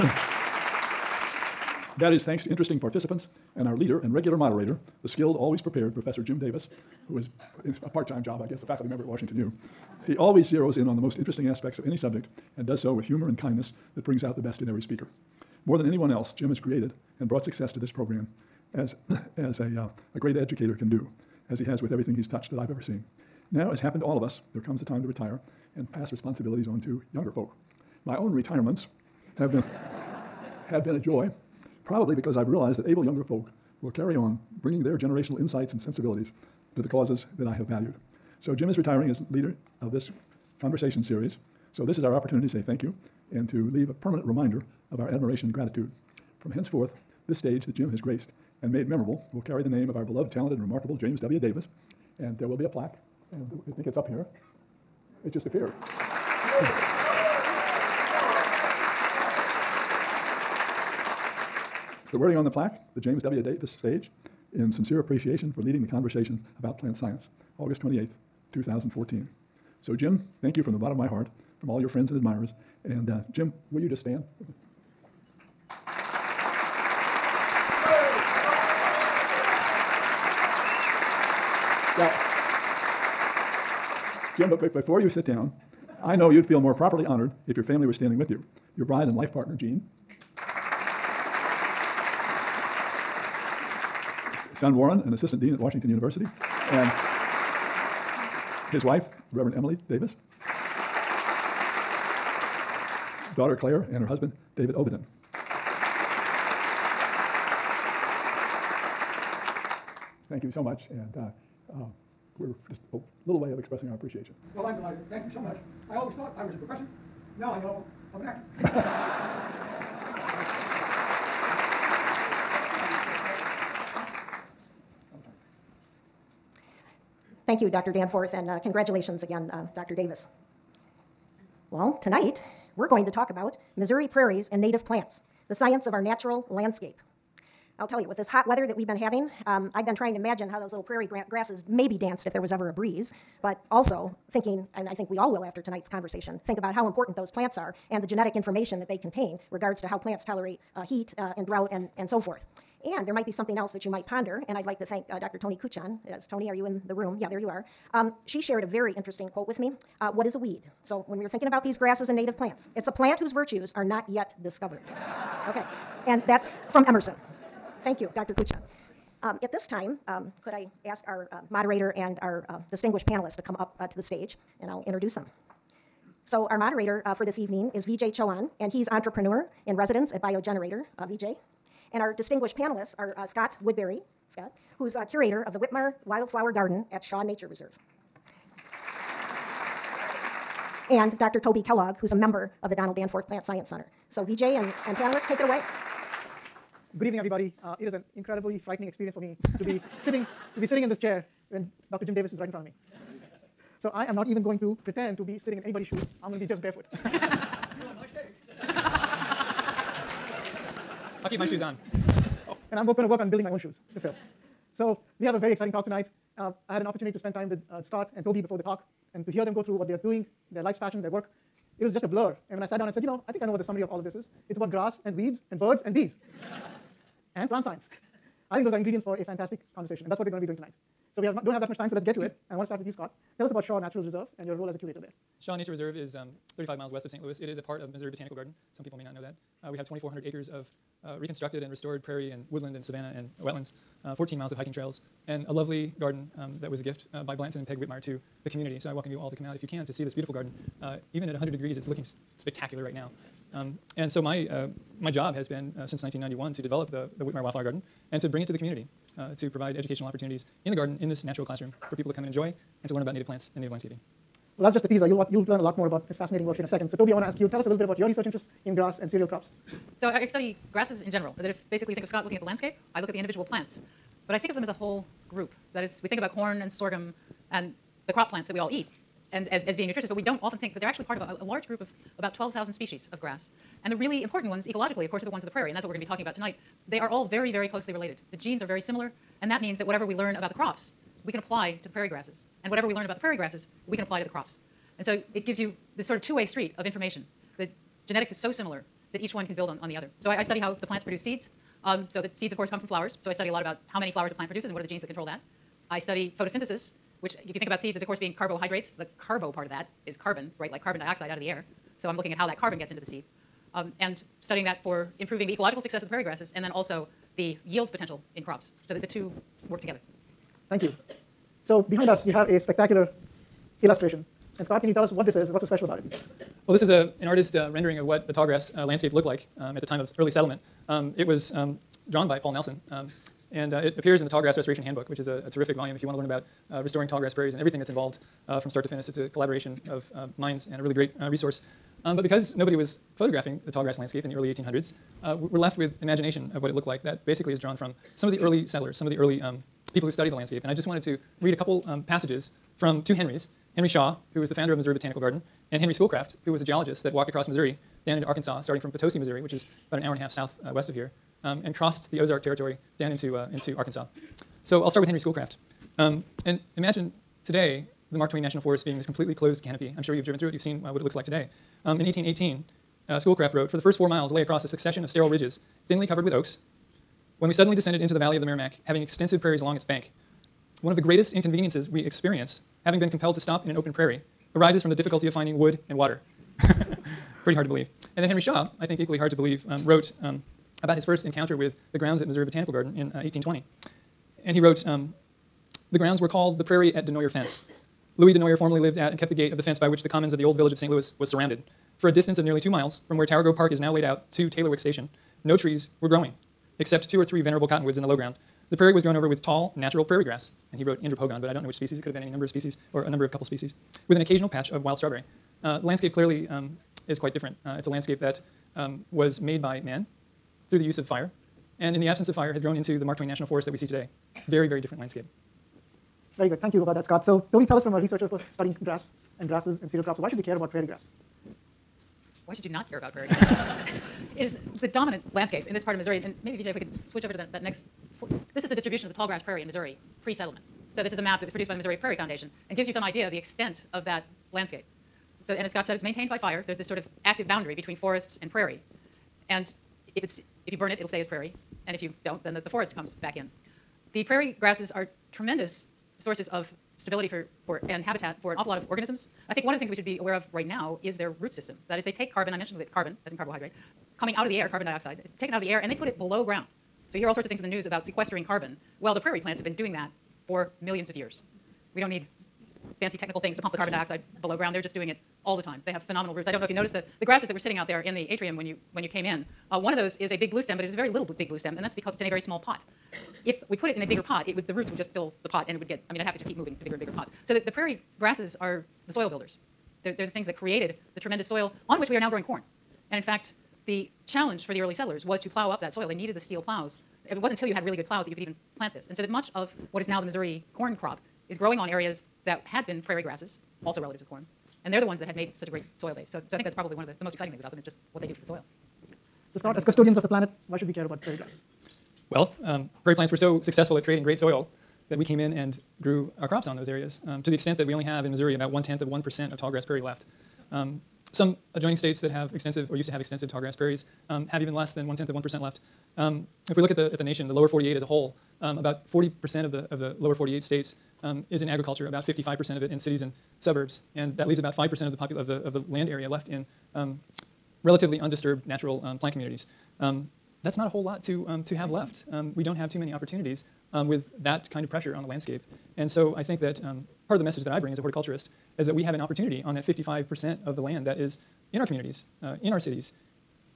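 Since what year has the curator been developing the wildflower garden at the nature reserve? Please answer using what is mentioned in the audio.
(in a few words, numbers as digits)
1991.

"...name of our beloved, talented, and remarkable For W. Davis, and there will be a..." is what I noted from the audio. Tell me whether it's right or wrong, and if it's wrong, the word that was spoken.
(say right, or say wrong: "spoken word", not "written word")
wrong: "James", not "For".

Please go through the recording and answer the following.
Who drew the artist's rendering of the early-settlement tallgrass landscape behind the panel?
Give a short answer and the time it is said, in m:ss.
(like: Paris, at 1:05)
Paul Nelson, at 5:32.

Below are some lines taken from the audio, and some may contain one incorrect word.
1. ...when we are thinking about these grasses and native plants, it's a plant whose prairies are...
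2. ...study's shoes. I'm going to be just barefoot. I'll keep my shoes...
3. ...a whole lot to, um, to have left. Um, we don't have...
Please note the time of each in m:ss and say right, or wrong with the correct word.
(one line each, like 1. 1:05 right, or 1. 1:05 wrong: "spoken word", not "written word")
1. 2:41 wrong: "virtues", not "prairies"
2. 3:25 wrong: "anybody", not "study"
3. 9:00 right.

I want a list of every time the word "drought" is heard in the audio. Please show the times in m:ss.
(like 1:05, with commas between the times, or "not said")
2:31.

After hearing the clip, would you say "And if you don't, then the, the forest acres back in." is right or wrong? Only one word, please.
wrong.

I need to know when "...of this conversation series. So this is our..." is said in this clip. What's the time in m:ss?
0:39.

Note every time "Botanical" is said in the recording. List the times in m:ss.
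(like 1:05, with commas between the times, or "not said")
3:58, 5:54, 6:32.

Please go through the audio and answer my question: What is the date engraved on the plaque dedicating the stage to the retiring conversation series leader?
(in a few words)
August 28th, 2014.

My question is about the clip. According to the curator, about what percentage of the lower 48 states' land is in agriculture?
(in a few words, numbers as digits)
40%.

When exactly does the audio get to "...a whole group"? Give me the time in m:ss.
4:34.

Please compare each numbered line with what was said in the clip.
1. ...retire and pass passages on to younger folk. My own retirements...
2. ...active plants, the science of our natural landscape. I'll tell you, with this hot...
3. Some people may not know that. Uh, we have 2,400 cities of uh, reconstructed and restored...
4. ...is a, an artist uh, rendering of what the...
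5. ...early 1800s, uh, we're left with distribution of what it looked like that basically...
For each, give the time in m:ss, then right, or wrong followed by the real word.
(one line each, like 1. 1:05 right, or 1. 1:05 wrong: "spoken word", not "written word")
1. 0:25 wrong: "responsibilities", not "passages"
2. 2:14 wrong: "native", not "active"
3. 3:58 wrong: "acres", not "cities"
4. 5:26 right
5. 5:44 wrong: "imagination", not "distribution".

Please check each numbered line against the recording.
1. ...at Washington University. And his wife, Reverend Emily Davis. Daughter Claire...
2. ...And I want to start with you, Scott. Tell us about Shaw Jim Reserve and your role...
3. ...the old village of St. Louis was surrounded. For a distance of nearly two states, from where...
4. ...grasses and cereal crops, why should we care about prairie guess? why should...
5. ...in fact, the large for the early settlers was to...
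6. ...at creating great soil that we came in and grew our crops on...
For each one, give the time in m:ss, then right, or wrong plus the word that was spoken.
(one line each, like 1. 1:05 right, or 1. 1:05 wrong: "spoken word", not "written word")
1. 1:35 right
2. 3:52 wrong: "Natural", not "Jim"
3. 6:40 wrong: "miles", not "states"
4. 7:09 wrong: "grass", not "guess"
5. 8:13 wrong: "challenge", not "large"
6. 8:33 right.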